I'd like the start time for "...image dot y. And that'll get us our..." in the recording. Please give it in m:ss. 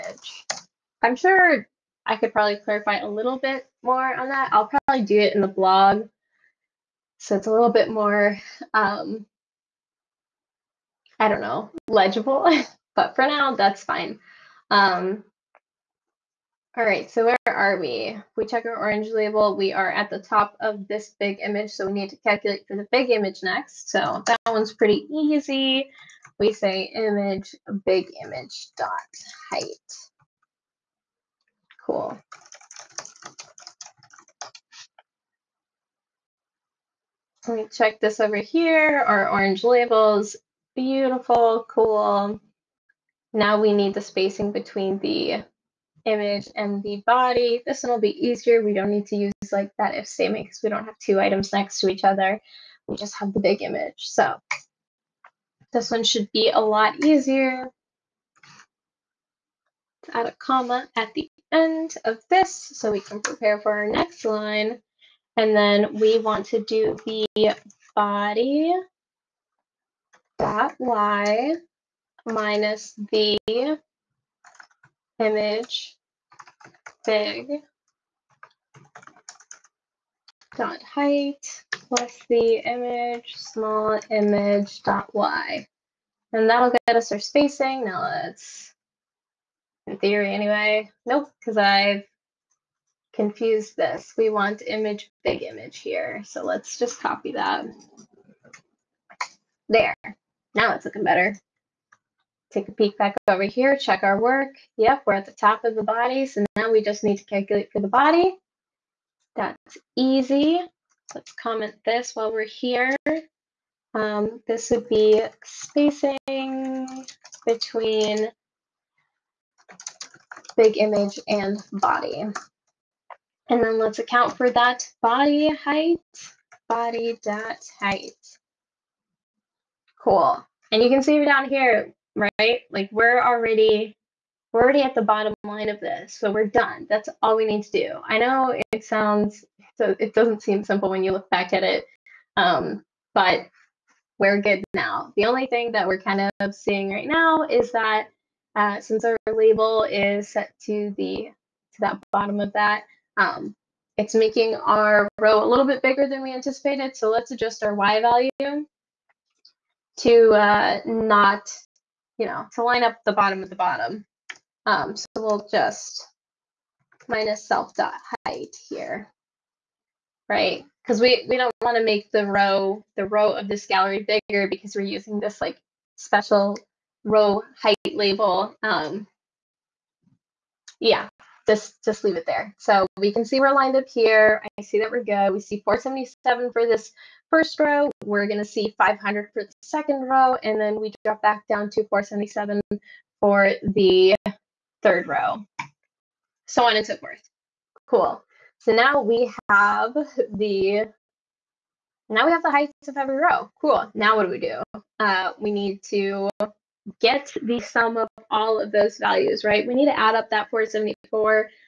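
1:24.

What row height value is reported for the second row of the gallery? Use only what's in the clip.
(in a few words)
500.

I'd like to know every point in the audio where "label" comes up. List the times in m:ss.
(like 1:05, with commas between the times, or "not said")
0:19, 0:39, 2:29, 2:57.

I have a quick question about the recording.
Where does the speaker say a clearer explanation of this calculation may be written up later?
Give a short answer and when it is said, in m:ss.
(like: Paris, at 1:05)
the blog, at 0:05.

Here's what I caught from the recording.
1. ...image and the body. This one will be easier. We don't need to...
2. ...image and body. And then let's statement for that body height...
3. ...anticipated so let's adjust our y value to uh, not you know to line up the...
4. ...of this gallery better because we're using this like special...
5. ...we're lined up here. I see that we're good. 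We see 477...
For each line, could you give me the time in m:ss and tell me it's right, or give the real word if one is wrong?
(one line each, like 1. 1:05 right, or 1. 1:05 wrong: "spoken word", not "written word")
1. 0:46 right
2. 2:00 wrong: "account", not "statement"
3. 2:36 right
4. 2:53 wrong: "bigger", not "better"
5. 3:03 right.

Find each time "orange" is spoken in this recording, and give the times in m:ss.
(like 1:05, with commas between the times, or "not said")
0:18, 0:39.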